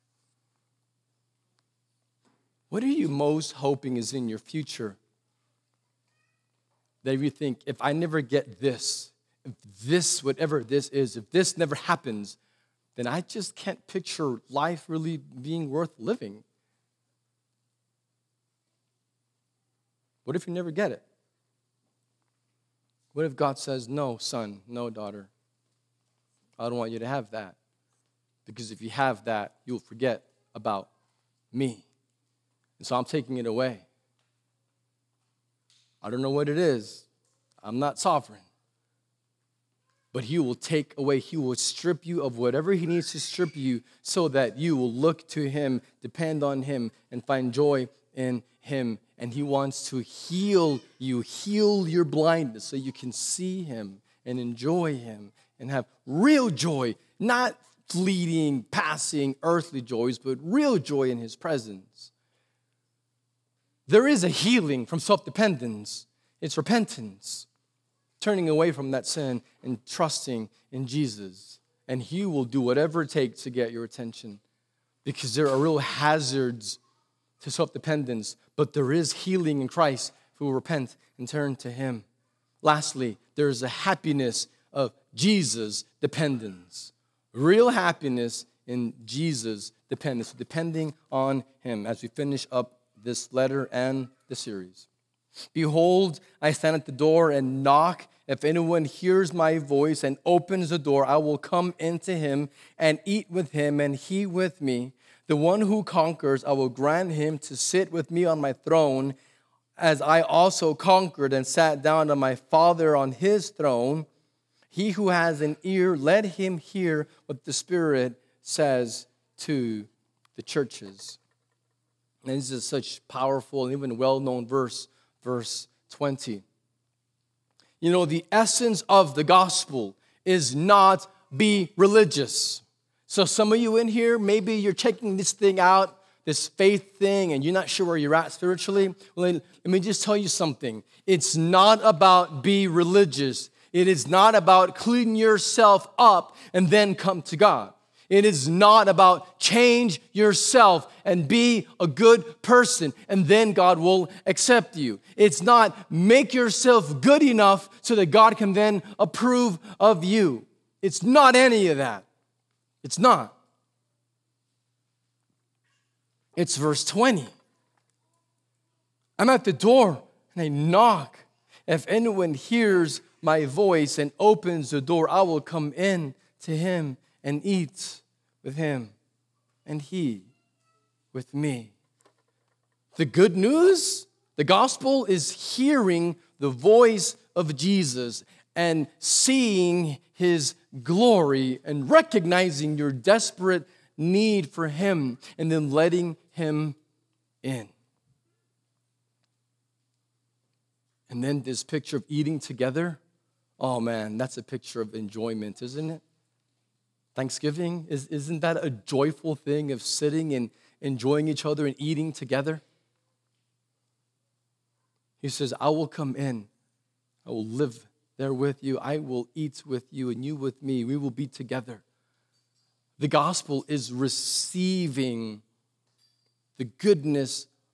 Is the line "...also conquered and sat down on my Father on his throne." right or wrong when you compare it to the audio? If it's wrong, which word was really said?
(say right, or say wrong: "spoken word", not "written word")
right.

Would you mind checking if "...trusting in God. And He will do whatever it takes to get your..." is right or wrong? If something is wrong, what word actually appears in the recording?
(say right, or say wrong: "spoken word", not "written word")
wrong: "Jesus", not "God".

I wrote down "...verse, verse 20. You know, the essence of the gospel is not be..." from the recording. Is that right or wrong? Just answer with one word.
right.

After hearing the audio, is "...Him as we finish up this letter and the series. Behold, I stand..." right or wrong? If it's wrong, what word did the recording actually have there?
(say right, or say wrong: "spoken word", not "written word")
right.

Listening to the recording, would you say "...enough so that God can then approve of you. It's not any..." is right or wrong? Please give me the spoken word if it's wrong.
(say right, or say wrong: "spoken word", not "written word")
right.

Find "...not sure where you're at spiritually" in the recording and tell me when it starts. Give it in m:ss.
2:17.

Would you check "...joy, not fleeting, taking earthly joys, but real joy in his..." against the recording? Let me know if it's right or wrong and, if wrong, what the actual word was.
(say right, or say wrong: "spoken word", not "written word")
wrong: "passing", not "taking".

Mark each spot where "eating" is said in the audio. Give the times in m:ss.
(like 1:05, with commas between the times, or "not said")
3:22, 3:31.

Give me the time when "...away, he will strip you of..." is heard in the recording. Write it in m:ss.
0:40.